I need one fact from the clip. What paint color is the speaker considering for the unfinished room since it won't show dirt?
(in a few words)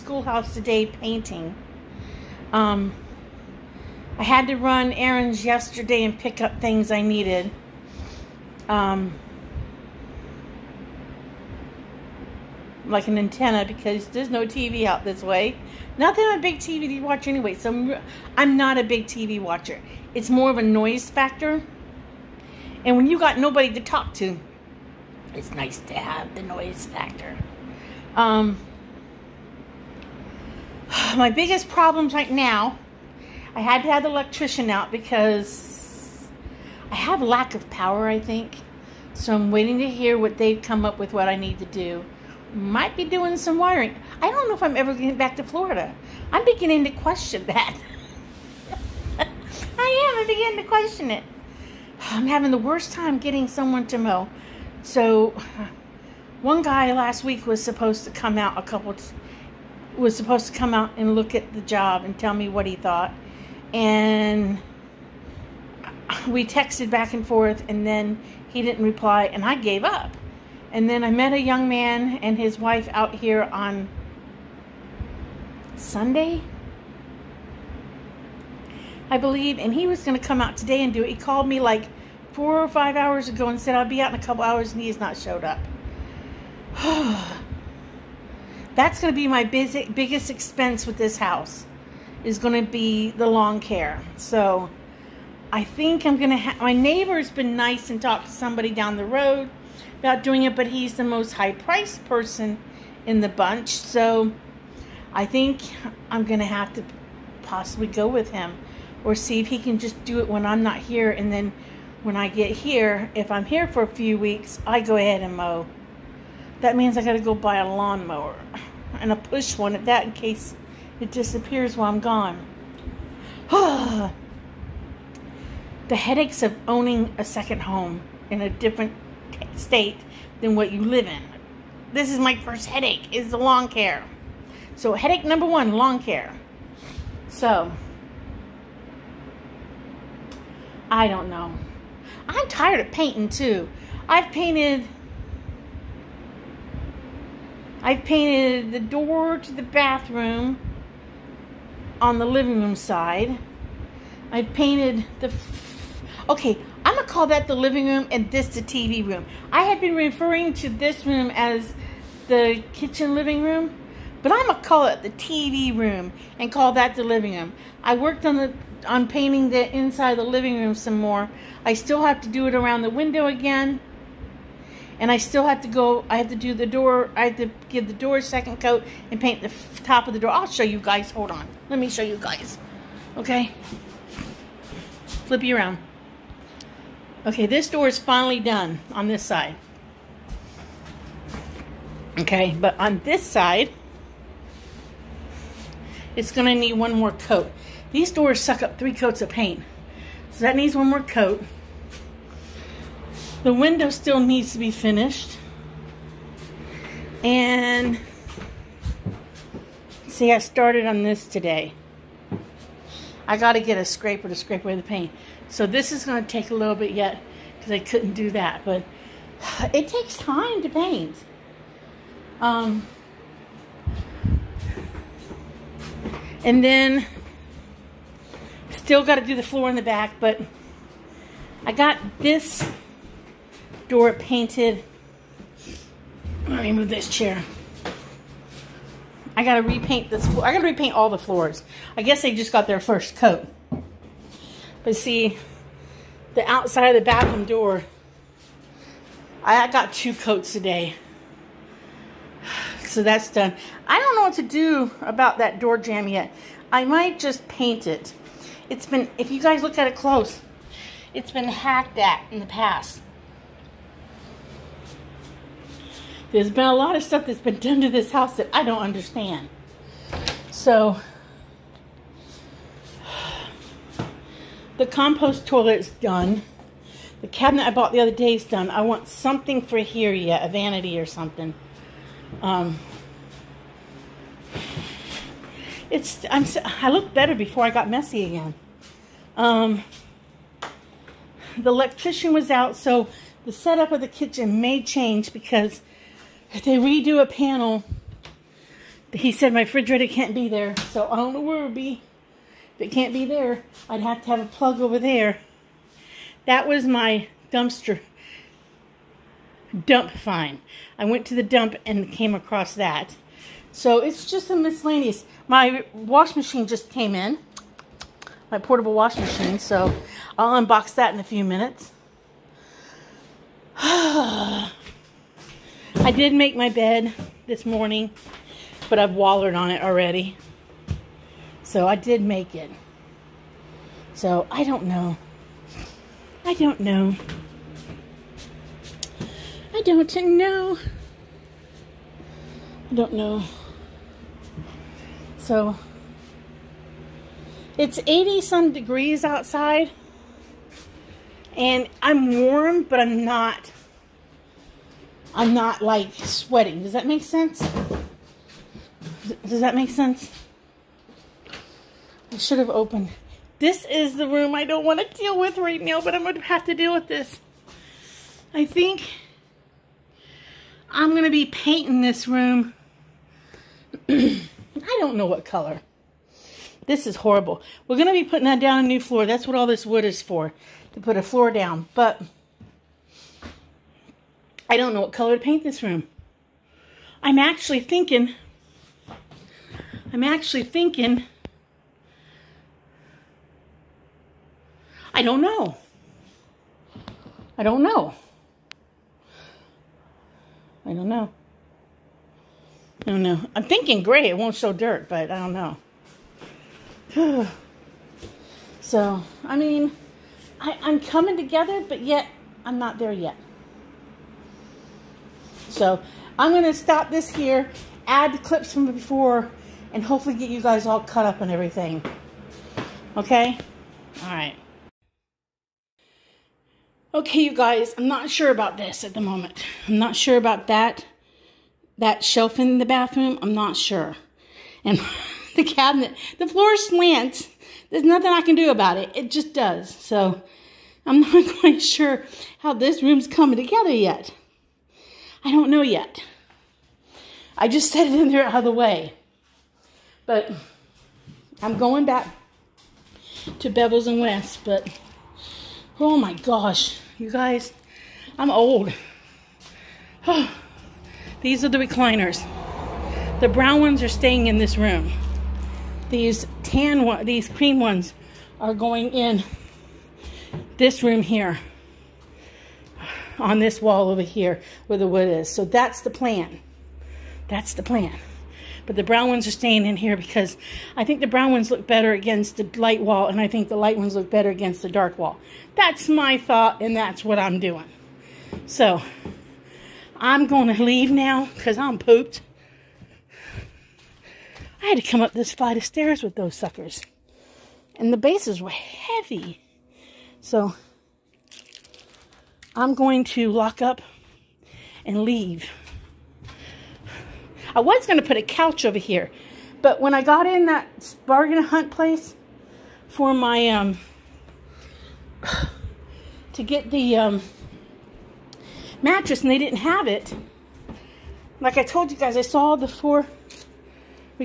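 gray.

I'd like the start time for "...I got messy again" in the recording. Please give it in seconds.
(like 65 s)
287 s.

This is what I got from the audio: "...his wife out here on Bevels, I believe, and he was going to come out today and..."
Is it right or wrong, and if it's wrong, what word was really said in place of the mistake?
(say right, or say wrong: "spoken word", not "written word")
wrong: "Sunday", not "Bevels".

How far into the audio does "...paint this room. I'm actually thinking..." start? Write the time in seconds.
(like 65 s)
385 s.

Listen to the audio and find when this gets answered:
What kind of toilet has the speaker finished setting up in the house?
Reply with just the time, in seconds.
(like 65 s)
274 s.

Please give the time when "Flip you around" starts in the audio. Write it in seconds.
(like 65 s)
185 s.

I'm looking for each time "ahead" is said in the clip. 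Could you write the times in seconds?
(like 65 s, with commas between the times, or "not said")
114 s.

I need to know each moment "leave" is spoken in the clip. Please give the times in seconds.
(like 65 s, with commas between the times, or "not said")
490 s, 505 s.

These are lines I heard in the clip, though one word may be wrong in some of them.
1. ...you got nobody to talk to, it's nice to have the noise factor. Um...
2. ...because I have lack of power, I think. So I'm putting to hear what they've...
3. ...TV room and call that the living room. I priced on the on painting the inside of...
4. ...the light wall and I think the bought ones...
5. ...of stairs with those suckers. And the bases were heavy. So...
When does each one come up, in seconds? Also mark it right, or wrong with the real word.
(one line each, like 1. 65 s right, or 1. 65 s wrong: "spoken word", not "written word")
1. 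23 s right
2. 34 s wrong: "waiting", not "putting"
3. 165 s wrong: "worked", not "priced"
4. 482 s wrong: "light", not "bought"
5. 495 s right.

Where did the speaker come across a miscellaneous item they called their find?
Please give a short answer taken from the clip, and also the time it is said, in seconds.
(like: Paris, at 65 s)
the dump, at 311 s.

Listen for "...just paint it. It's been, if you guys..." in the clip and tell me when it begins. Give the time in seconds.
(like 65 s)
257 s.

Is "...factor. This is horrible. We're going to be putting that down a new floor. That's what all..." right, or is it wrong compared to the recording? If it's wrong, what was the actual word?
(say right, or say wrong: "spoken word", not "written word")
wrong: "color", not "factor".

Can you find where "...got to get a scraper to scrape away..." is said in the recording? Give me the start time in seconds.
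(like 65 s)
213 s.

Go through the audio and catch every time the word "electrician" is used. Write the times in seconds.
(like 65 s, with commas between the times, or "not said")
34 s, 291 s.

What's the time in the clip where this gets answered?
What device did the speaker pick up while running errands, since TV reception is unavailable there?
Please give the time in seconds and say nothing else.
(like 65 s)
13 s.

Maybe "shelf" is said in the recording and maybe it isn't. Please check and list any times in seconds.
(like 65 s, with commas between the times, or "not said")
432 s.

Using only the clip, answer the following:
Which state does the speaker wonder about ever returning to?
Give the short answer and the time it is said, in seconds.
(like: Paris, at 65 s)
Florida, at 45 s.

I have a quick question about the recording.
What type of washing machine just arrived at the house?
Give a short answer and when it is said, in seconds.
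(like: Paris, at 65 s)
portable, at 318 s.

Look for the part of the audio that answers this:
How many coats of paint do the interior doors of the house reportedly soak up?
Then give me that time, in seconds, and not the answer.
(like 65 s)
198 s.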